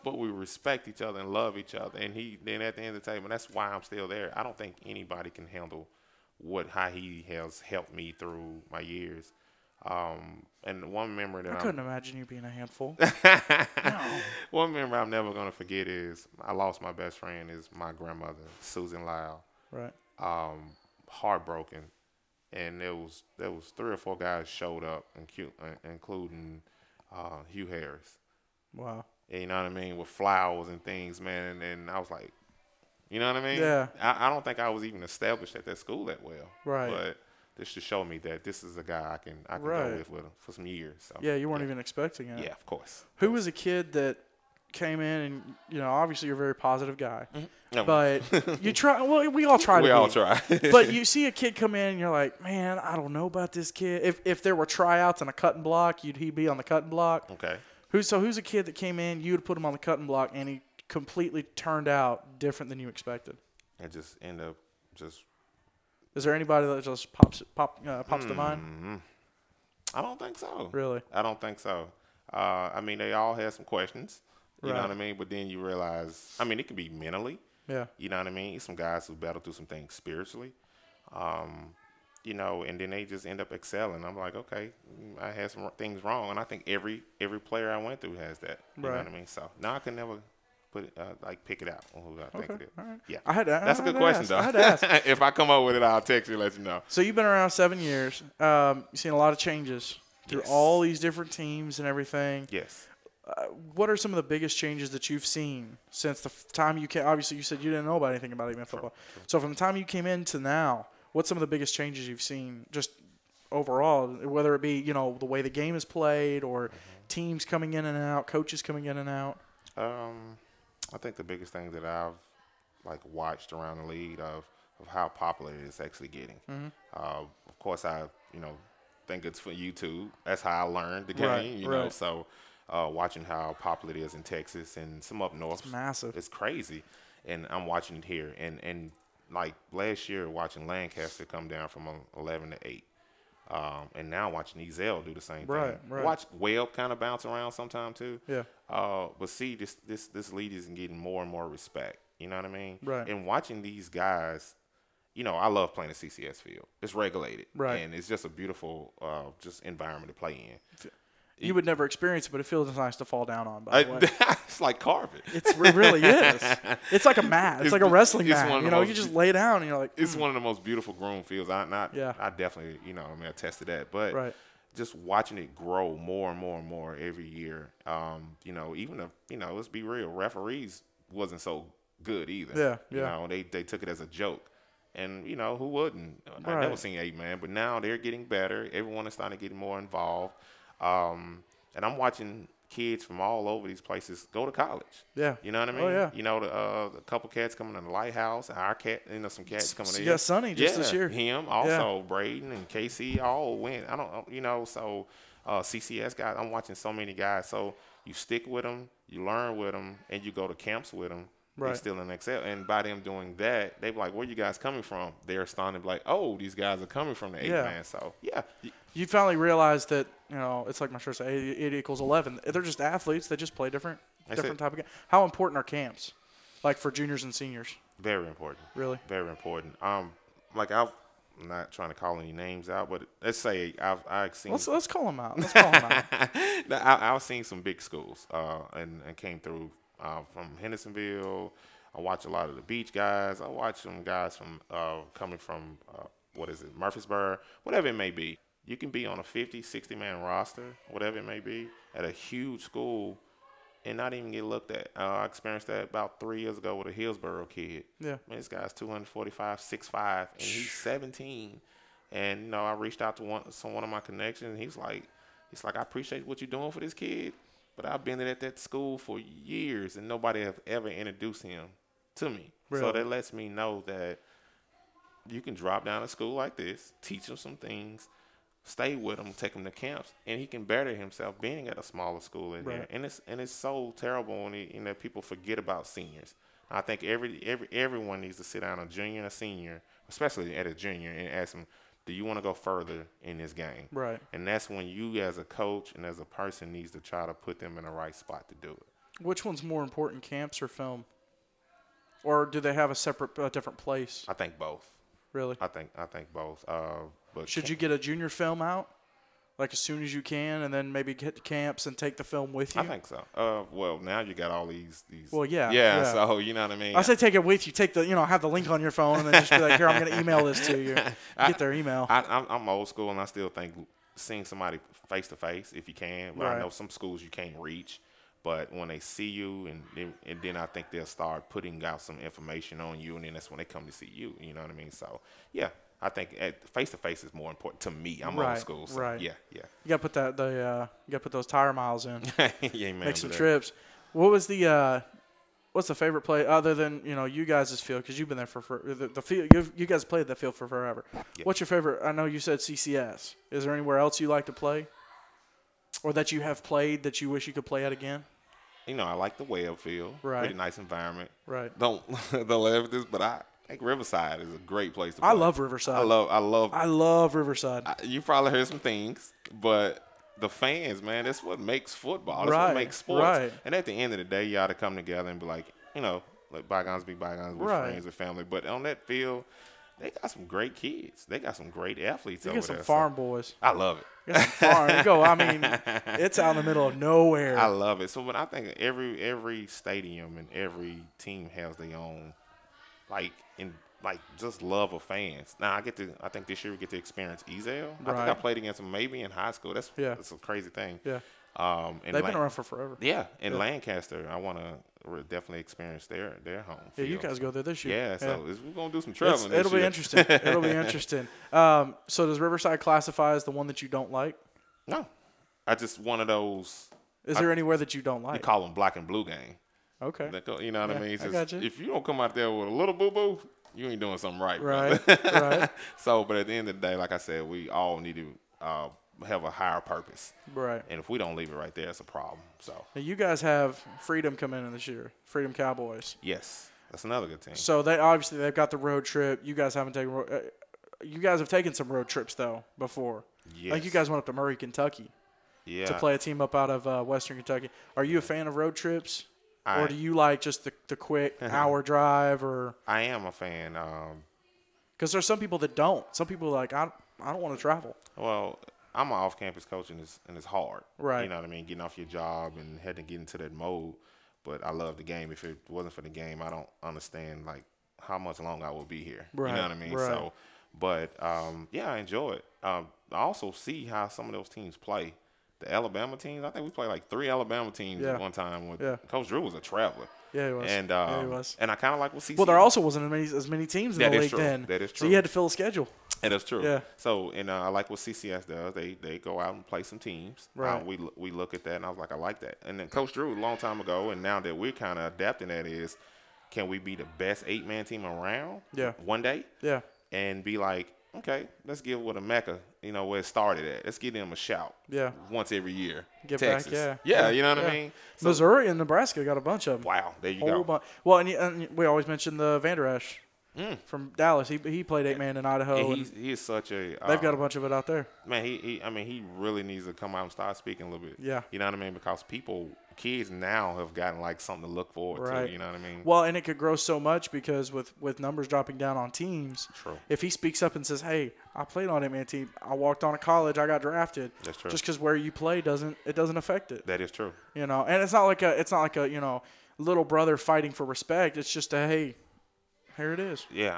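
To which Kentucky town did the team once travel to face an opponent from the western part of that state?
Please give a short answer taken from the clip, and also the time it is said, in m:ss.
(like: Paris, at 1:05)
Murray, at 7:24.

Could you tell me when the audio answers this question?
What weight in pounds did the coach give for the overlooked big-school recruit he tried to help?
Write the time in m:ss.
4:18.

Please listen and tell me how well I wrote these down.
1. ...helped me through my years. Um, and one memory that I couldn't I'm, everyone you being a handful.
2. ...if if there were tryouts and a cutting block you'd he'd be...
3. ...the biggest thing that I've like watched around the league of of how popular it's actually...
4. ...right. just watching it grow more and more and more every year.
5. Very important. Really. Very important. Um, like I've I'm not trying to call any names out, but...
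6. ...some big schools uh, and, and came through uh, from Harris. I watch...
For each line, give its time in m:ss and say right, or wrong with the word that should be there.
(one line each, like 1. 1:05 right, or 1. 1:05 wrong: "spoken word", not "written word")
1. 0:07 wrong: "imagine", not "everyone"
2. 0:54 right
3. 2:01 right
4. 2:54 right
5. 3:47 right
6. 3:57 wrong: "Hendersonville", not "Harris".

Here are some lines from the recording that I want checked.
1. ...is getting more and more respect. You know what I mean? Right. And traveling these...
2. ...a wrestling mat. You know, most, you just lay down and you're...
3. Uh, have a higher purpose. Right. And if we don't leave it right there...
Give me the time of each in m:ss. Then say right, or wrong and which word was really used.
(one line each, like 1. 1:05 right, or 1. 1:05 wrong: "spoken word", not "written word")
1. 2:30 wrong: "watching", not "traveling"
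2. 2:47 right
3. 7:08 right.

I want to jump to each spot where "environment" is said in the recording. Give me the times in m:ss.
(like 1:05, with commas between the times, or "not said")
2:39, 6:00.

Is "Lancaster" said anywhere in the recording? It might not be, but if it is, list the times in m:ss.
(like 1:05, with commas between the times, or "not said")
2:20, 6:43.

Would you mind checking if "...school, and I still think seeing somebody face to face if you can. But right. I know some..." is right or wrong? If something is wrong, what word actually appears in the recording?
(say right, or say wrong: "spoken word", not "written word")
right.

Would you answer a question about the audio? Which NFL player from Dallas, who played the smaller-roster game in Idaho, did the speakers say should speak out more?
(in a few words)
Vander Esch.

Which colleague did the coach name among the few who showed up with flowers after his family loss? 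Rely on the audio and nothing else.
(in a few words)
Hugh Harris.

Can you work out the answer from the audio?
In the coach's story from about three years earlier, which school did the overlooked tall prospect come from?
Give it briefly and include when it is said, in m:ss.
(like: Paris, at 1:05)
Hillsboro, at 4:16.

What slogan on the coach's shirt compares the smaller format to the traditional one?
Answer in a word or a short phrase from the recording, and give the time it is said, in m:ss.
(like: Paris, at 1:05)
eight equals eleven, at 3:41.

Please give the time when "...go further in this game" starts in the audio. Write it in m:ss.
4:52.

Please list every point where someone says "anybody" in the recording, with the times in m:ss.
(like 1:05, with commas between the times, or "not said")
0:04, 1:06.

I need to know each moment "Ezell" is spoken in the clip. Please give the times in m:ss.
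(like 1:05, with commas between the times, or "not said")
2:24, 6:37.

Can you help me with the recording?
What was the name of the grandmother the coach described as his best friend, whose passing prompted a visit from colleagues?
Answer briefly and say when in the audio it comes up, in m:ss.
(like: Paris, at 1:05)
Susan Lyle, at 0:18.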